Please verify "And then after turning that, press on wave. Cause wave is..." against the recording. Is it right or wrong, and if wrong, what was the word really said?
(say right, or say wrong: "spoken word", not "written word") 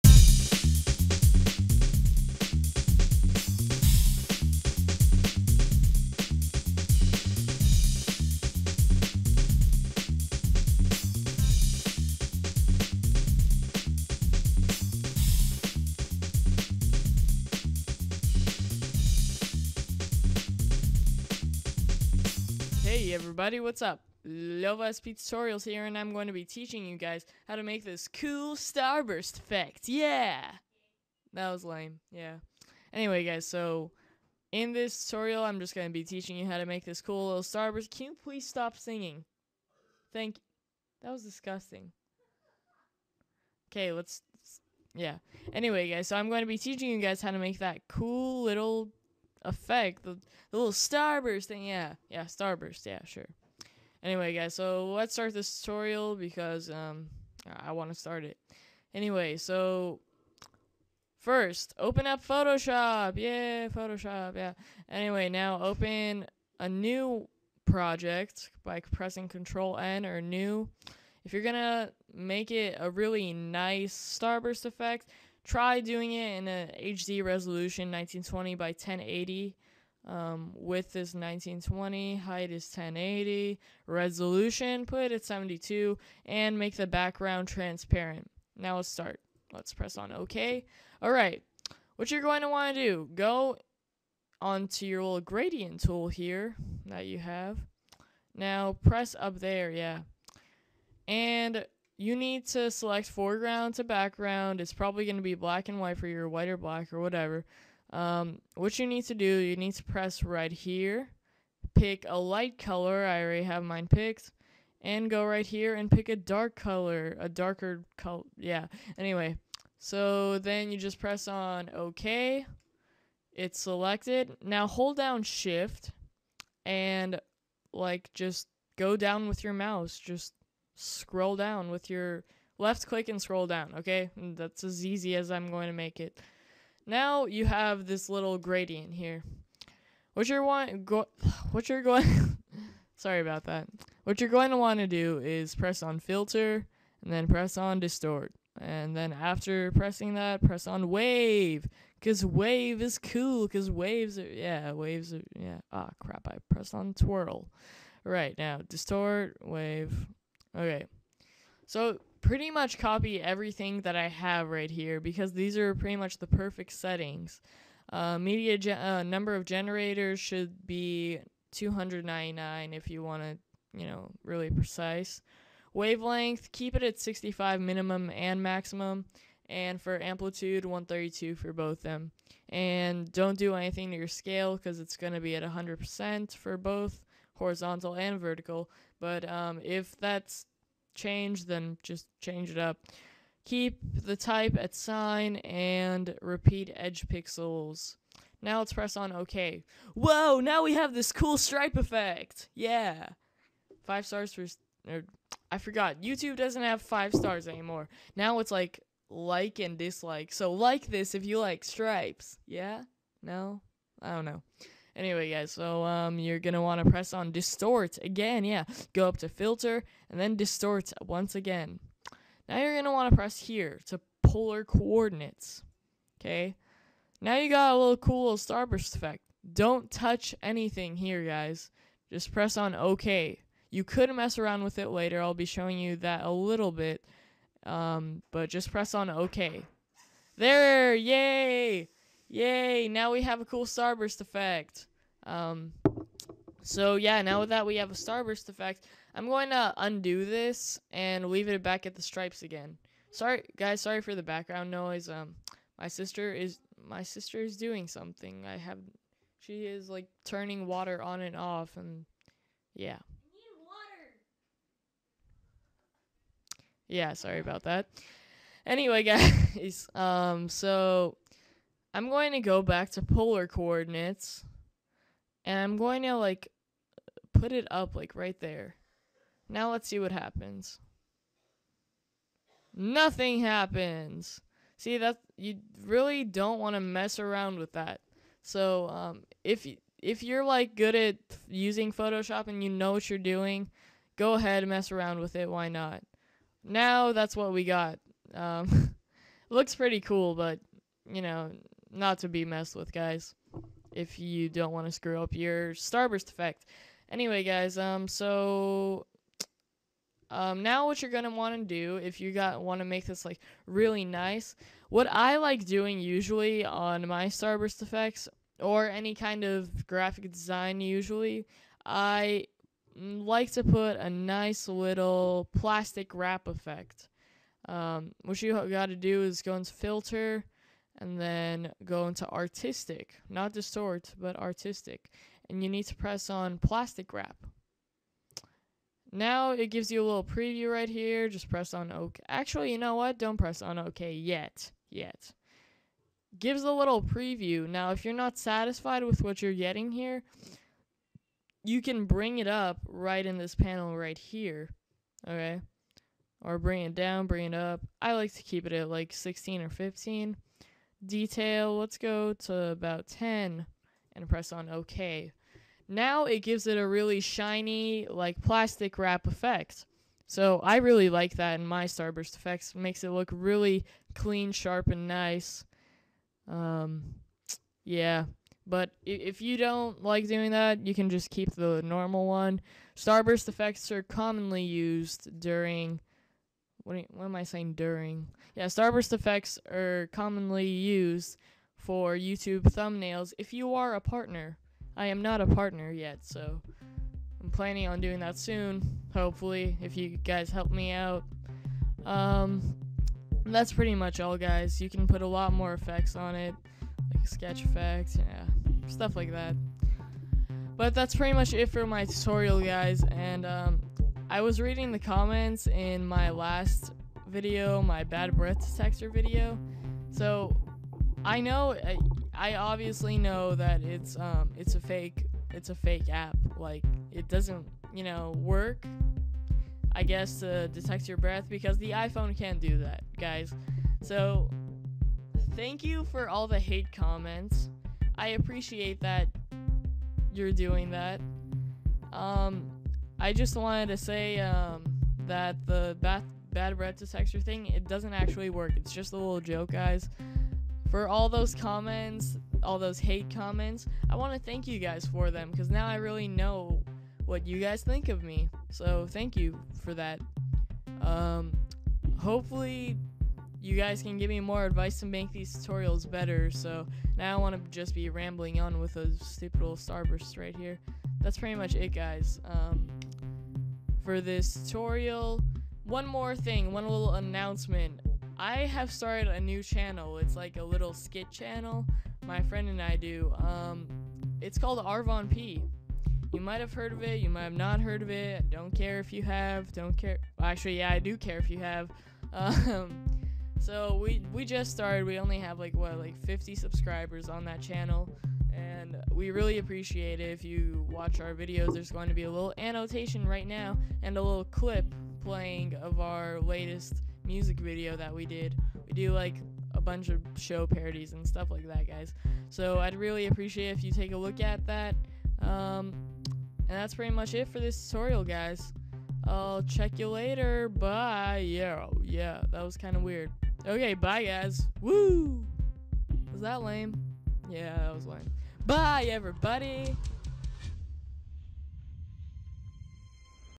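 wrong: "pressing", not "turning".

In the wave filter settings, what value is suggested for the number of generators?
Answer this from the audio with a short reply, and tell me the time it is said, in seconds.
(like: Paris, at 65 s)
299, at 171 s.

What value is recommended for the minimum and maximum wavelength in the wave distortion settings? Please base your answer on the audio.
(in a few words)
65.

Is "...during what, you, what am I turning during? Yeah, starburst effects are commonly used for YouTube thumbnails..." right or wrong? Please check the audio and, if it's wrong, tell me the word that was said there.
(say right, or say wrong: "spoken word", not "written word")
wrong: "saying", not "turning".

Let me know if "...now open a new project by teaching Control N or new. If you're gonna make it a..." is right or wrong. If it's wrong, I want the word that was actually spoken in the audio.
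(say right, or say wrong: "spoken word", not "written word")
wrong: "pressing", not "teaching".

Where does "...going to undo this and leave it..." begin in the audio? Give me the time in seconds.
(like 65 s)
249 s.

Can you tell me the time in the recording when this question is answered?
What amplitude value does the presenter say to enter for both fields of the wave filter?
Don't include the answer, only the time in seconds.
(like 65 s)
180 s.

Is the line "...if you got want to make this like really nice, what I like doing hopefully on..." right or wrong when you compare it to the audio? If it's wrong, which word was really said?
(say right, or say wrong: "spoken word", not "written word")
wrong: "usually", not "hopefully".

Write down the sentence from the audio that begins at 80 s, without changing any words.
Um, width is 1920, height is 1080, resolution put it at 72, and make the background transparent.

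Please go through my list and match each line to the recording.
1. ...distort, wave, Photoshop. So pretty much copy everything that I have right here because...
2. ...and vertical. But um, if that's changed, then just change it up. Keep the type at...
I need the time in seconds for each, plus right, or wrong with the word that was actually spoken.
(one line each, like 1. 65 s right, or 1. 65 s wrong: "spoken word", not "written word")
1. 158 s wrong: "Okay", not "Photoshop"
2. 187 s right.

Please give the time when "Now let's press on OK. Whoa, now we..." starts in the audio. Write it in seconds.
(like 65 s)
198 s.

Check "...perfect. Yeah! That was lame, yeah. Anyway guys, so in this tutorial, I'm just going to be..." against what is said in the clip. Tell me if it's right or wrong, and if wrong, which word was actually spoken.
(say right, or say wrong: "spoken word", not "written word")
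wrong: "effect", not "perfect".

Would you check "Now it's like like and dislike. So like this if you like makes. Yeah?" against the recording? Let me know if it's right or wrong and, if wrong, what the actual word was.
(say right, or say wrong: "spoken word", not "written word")
wrong: "stripes", not "makes".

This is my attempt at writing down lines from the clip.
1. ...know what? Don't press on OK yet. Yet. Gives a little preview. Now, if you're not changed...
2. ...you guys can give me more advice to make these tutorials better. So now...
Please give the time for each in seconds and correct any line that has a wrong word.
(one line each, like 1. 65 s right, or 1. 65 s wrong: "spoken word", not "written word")
1. 342 s wrong: "satisfied", not "changed"
2. 463 s right.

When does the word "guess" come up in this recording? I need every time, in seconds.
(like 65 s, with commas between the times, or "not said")
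430 s.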